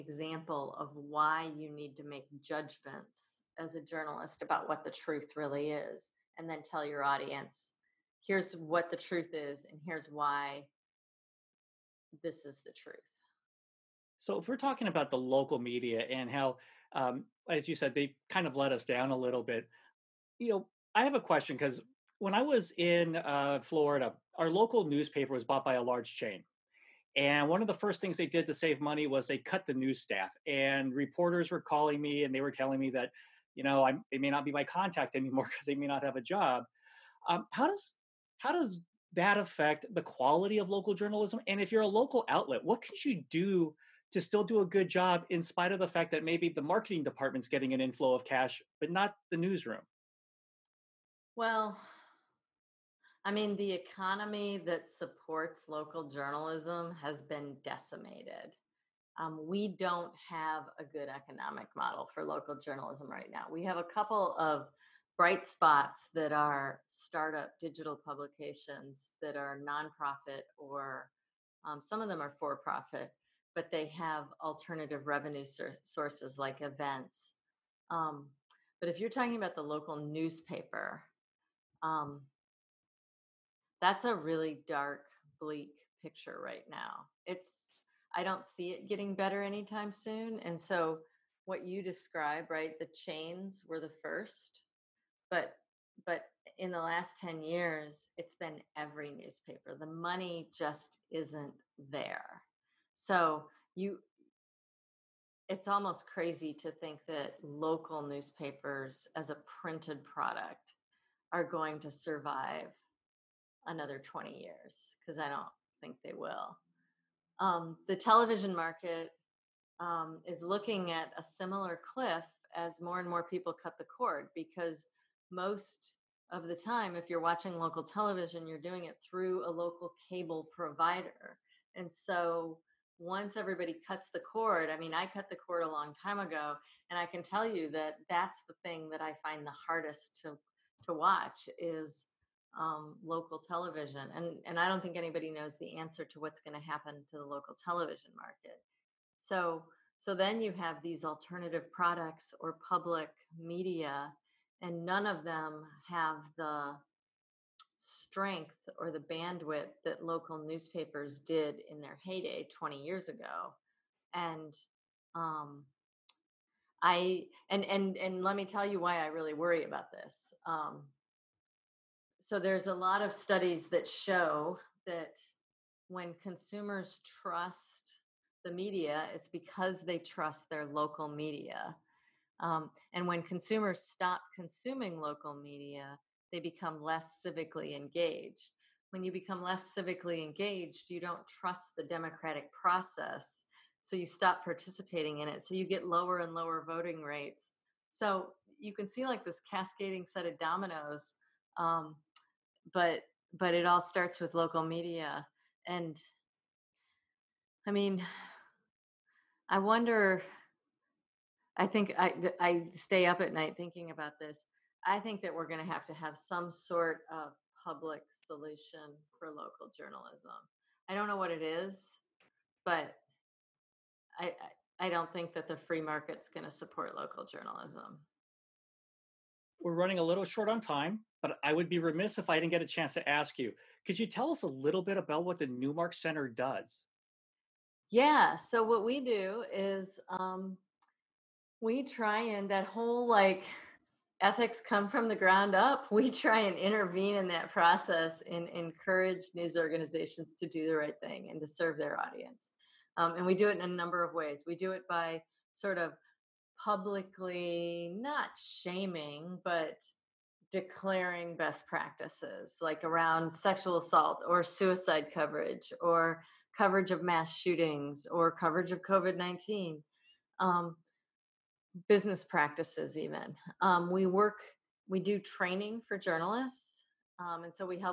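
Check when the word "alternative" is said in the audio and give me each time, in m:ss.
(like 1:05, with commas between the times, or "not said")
1:14, 2:31.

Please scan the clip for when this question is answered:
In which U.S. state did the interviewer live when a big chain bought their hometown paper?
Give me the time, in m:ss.
0:23.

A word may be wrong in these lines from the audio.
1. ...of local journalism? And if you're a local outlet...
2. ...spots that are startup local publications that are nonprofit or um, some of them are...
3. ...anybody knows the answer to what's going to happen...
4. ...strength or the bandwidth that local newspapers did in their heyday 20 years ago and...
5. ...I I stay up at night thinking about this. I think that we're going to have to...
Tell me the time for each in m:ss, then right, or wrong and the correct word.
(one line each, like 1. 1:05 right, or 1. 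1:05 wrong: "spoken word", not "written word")
1. 0:40 right
2. 1:05 wrong: "digital", not "local"
3. 2:24 right
4. 2:37 right
5. 3:31 right.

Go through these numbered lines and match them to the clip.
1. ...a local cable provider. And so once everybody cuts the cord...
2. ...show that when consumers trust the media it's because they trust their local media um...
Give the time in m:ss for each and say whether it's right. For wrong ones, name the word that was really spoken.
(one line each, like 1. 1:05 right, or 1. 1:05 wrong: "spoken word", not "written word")
1. 2:09 right
2. 2:53 right.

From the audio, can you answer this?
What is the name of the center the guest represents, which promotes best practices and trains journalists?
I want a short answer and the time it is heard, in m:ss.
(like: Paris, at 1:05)
Newmark Center, at 3:55.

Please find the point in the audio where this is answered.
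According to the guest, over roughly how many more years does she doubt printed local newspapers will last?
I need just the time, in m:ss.
1:53.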